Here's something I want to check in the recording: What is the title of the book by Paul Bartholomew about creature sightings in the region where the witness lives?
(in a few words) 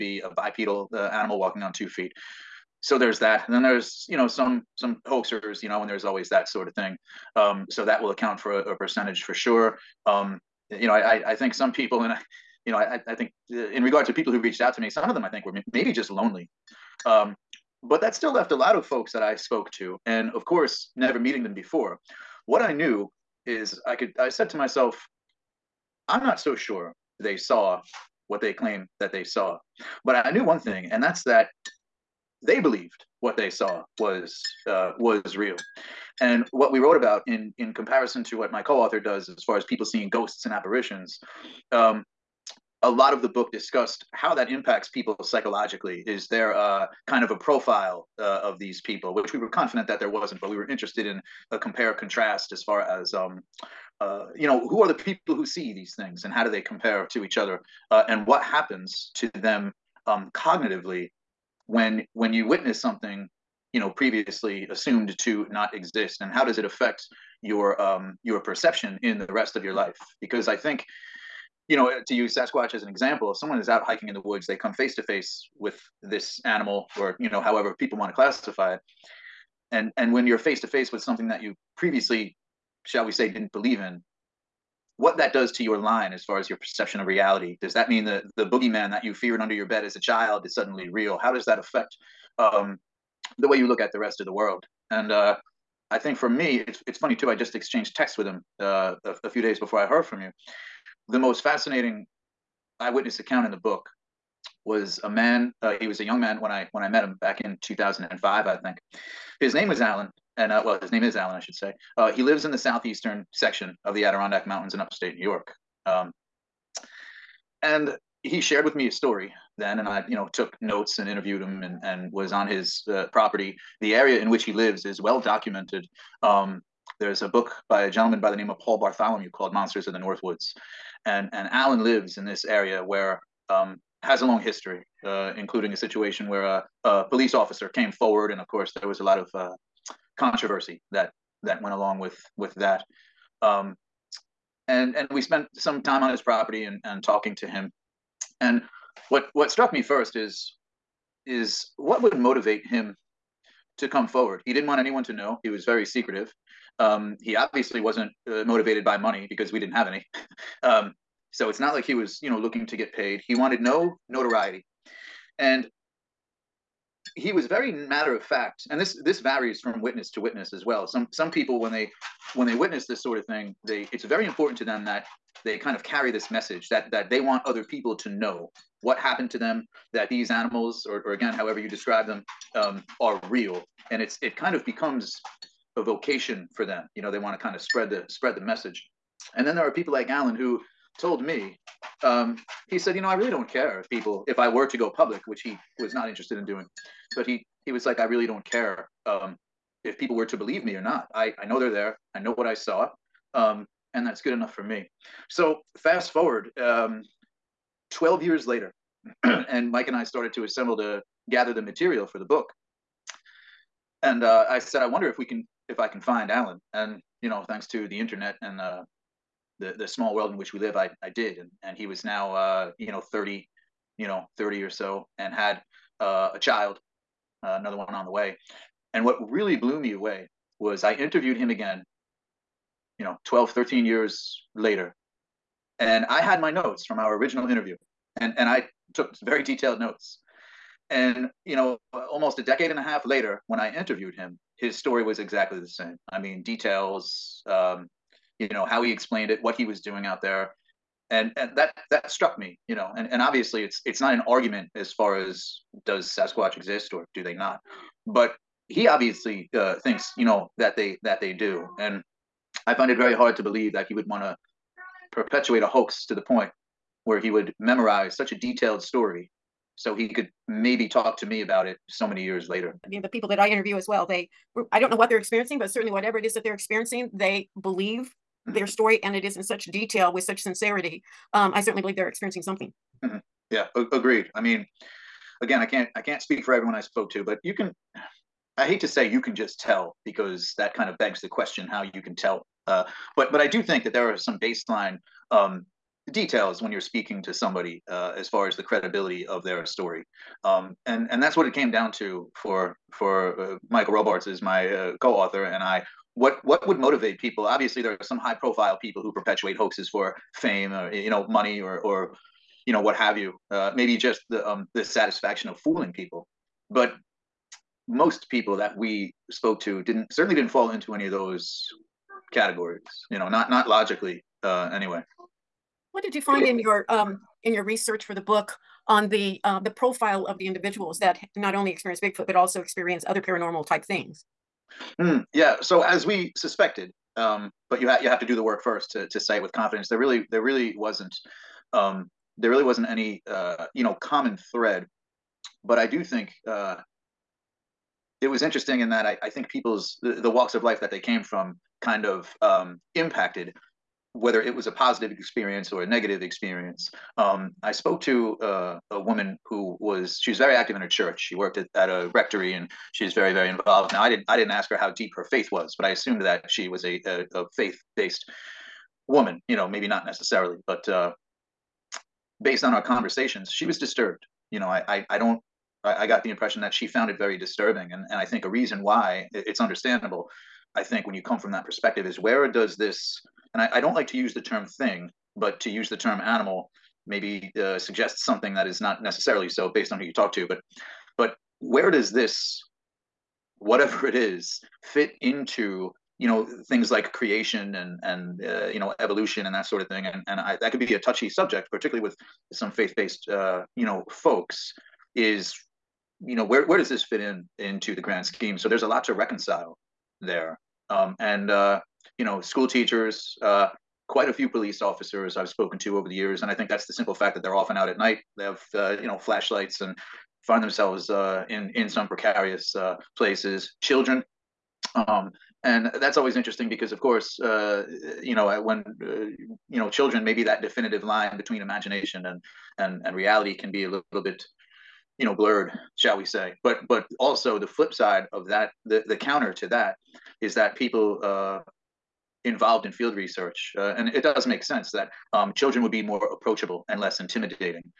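Monsters of the North Woods.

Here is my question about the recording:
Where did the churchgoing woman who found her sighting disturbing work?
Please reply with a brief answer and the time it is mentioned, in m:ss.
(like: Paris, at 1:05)
A rectory, at 6:02.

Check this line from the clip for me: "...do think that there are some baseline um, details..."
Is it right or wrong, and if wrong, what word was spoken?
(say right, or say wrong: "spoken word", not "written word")
right.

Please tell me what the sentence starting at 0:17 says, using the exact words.
Um, but that still left a lot of folks that I spoke to, and of course, never meeting them before.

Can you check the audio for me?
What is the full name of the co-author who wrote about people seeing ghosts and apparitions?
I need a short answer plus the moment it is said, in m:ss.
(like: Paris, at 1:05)
Michael Robarts, at 5:03.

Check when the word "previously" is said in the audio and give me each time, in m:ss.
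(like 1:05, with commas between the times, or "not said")
1:03, 1:21.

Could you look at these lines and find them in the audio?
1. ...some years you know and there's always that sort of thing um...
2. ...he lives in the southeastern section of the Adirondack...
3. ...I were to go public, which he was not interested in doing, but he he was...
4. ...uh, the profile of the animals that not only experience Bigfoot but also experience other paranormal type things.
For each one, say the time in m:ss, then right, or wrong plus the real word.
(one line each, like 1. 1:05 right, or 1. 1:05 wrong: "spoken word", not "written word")
1. 0:04 wrong: "hoaxers", not "years"
2. 1:52 right
3. 3:14 right
4. 5:29 wrong: "individuals", not "animals".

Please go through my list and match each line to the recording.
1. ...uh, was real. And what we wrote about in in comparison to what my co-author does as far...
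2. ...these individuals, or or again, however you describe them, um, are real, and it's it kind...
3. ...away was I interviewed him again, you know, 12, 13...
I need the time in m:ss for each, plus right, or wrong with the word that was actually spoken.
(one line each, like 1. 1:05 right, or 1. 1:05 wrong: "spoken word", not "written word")
1. 0:34 right
2. 3:00 wrong: "animals", not "individuals"
3. 3:49 right.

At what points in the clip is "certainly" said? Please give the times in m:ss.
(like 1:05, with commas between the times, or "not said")
4:35, 4:41, 5:20.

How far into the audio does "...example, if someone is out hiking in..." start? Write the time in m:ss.
1:12.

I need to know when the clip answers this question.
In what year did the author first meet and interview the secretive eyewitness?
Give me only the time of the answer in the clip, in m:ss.
1:47.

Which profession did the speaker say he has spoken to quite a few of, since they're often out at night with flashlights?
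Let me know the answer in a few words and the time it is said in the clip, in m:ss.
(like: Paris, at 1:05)
Police officers, at 6:54.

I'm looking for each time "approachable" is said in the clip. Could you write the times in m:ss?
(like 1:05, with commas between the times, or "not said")
7:26.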